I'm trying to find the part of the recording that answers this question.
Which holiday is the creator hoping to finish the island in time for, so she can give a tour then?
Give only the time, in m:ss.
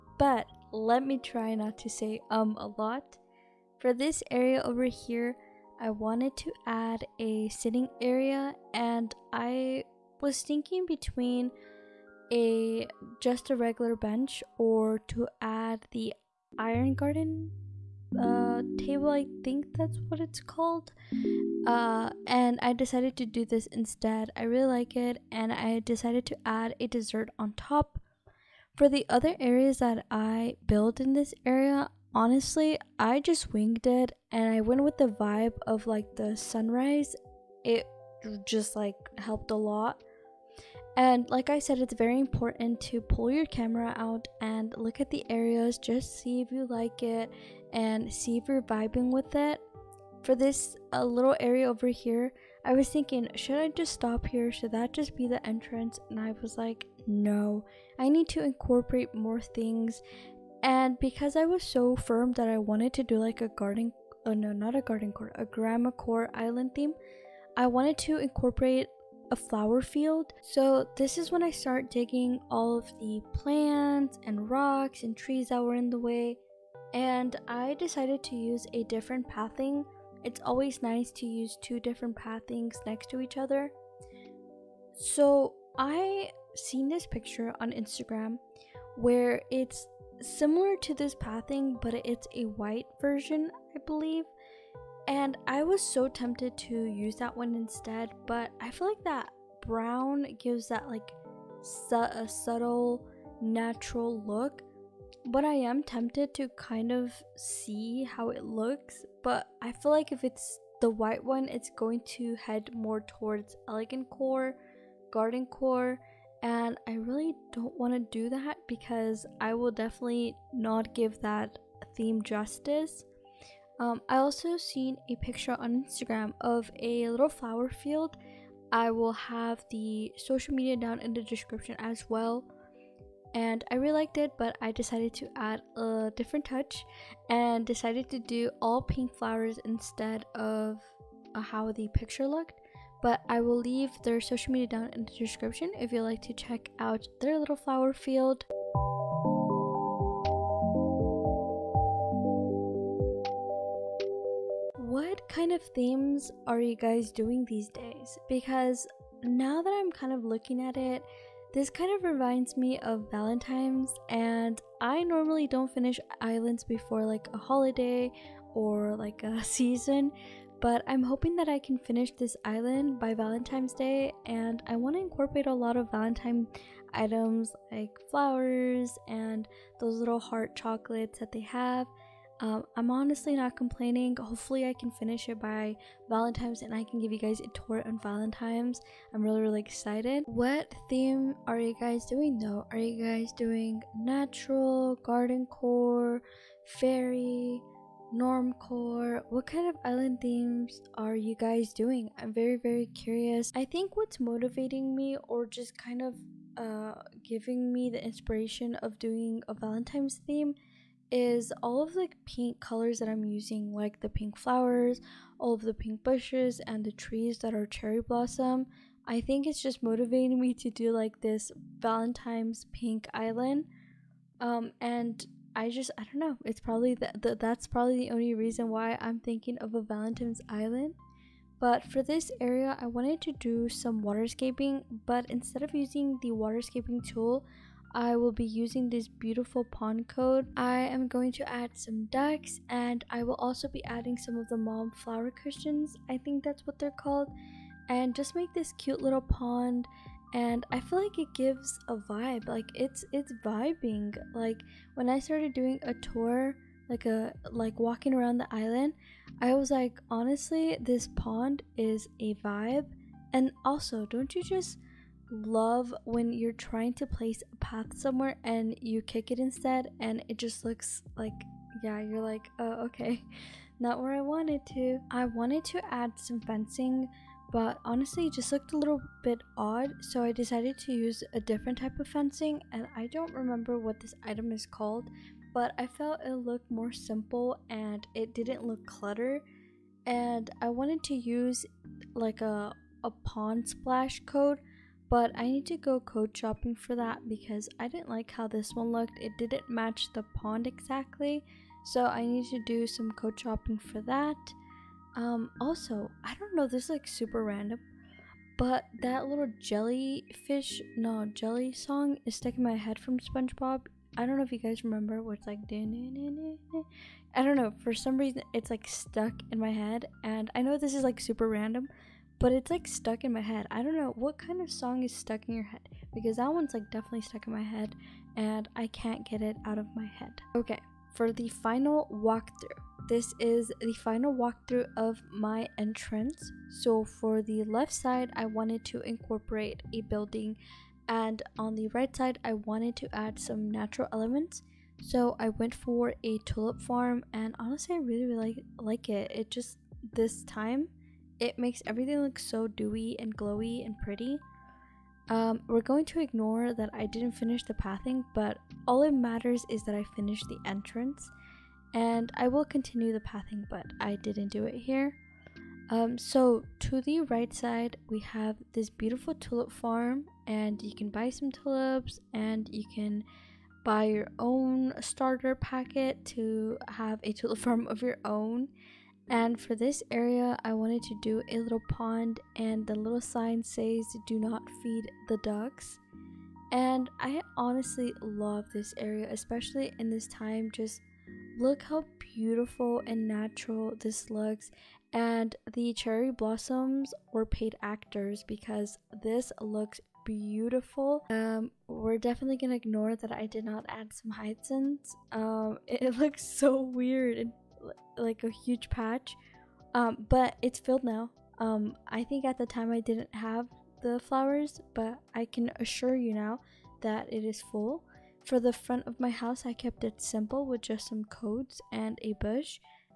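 2:53.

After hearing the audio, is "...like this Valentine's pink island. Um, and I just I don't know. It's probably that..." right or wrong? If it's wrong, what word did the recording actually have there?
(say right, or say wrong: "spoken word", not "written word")
right.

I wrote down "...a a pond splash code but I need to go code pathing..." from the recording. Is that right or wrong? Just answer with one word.
wrong.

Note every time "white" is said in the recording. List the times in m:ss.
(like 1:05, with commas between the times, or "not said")
1:32, 1:50.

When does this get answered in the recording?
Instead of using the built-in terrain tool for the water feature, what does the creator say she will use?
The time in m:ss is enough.
3:59.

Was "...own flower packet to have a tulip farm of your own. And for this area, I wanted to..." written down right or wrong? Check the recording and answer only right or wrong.
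wrong.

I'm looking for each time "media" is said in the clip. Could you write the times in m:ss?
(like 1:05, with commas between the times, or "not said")
2:10, 2:24.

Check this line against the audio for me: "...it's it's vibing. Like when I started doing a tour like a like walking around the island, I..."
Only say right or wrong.
right.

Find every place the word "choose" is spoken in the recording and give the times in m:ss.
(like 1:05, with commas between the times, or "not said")
not said.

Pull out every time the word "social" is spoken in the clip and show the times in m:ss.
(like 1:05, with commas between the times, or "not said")
2:10, 2:24.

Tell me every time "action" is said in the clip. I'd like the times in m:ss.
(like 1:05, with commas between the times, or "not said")
not said.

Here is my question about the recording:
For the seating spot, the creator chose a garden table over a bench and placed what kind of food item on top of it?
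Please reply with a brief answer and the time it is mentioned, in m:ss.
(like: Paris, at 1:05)
dessert, at 0:26.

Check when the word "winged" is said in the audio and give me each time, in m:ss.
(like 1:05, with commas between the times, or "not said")
0:33.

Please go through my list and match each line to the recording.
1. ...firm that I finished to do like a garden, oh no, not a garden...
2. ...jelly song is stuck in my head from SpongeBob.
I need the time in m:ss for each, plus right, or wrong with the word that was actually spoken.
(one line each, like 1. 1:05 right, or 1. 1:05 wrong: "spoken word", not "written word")
1. 1:01 wrong: "wanted", not "finished"
2. 5:11 right.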